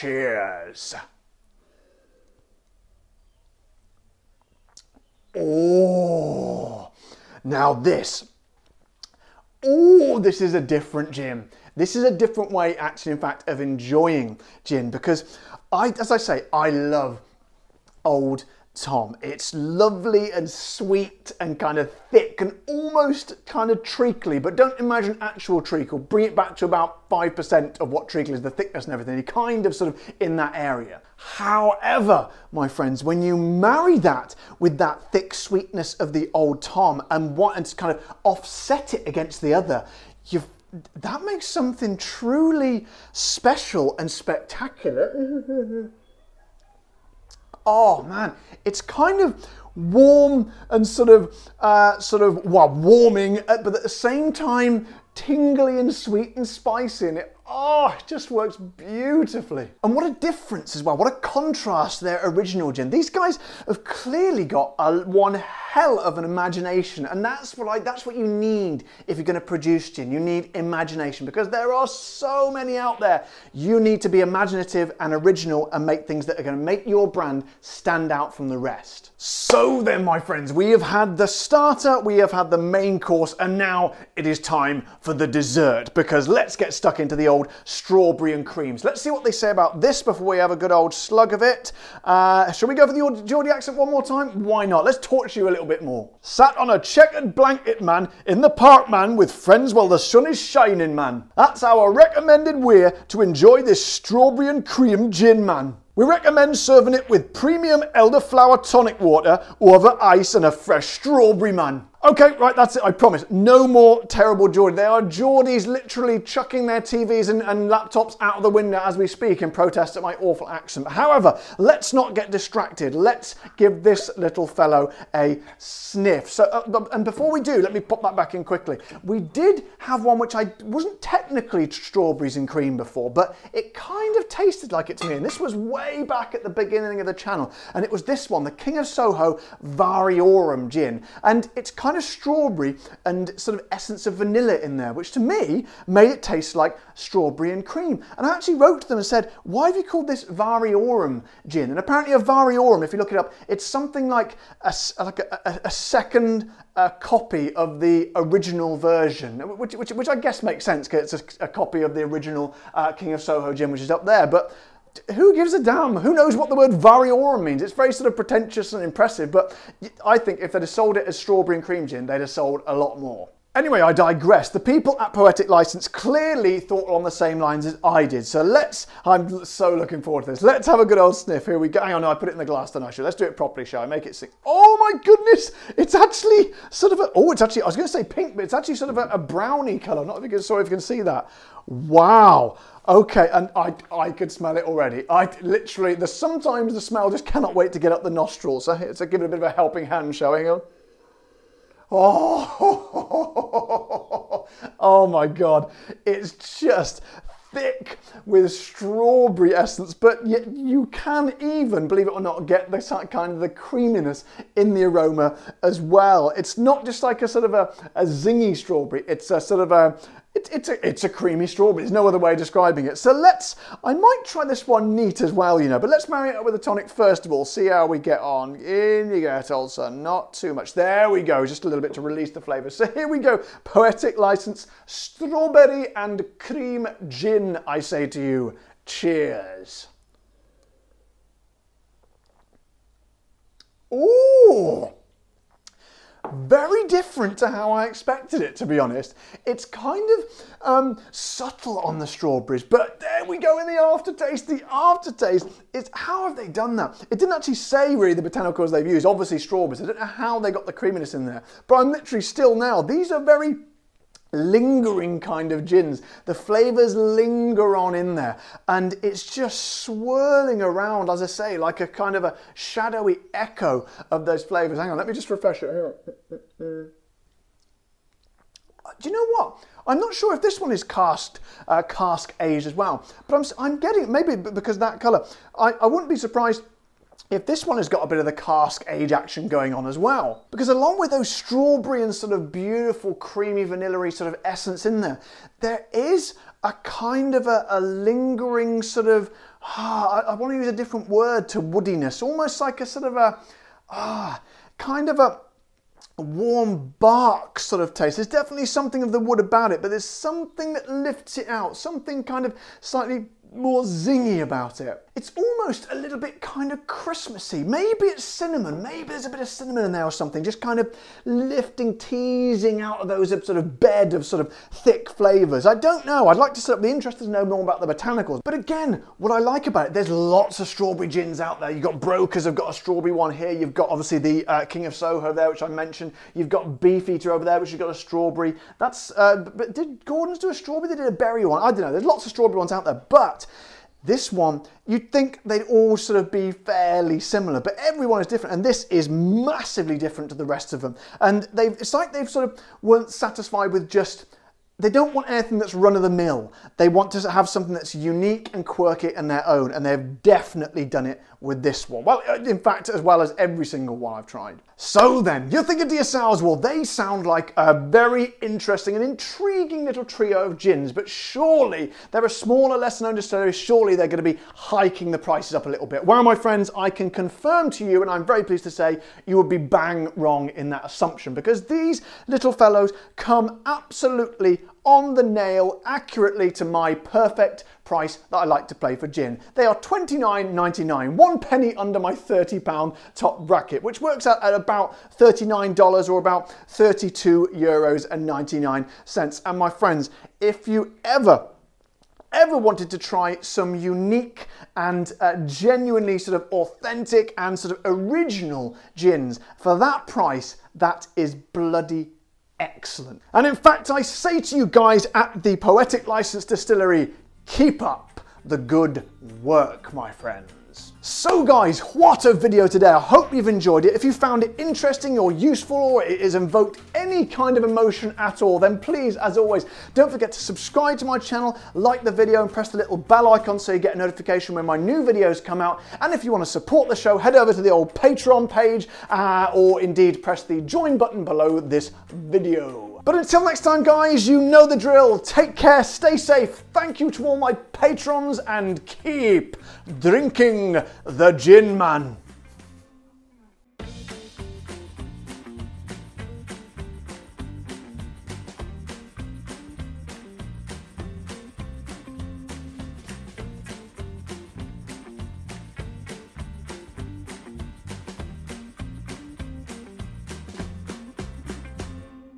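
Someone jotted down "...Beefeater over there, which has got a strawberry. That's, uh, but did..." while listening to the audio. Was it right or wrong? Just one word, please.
right.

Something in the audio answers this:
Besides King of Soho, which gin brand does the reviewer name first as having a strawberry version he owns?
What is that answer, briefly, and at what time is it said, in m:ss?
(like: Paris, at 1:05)
Brokers, at 5:32.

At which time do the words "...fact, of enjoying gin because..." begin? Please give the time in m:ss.
0:13.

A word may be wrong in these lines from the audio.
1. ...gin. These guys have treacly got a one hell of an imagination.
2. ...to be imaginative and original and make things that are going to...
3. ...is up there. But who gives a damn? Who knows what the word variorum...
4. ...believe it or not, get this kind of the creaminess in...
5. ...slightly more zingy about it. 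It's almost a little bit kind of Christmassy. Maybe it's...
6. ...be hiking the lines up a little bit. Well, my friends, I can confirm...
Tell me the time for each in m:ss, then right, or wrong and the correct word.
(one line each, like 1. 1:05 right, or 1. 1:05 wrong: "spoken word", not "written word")
1. 1:02 wrong: "clearly", not "treacly"
2. 1:14 right
3. 2:43 right
4. 3:31 right
5. 5:12 right
6. 6:14 wrong: "prices", not "lines".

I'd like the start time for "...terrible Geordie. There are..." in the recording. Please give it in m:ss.
1:54.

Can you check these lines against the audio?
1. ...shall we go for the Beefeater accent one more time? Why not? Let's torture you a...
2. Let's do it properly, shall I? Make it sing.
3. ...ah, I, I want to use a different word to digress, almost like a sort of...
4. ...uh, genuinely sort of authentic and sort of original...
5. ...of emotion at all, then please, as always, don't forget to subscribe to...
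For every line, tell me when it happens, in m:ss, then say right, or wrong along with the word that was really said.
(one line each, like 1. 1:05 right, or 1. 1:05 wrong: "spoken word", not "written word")
1. 1:32 wrong: "Geordie", not "Beefeater"
2. 3:03 right
3. 4:59 wrong: "woodiness", not "digress"
4. 6:45 right
5. 7:07 right.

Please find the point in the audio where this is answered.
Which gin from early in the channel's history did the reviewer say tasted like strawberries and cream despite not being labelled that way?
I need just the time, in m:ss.
2:18.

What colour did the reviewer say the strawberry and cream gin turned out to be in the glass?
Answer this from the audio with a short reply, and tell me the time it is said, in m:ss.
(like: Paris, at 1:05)
Brownie, at 3:09.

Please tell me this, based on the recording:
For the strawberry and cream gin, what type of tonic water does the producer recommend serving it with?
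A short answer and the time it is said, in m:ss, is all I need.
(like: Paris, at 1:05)
Premium elderflower tonic, at 1:47.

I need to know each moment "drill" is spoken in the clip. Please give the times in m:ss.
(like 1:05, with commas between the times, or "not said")
7:24.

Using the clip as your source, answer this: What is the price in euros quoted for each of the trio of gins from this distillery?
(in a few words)
32.99 euros.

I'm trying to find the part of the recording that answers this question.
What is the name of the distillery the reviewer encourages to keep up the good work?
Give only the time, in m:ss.
6:55.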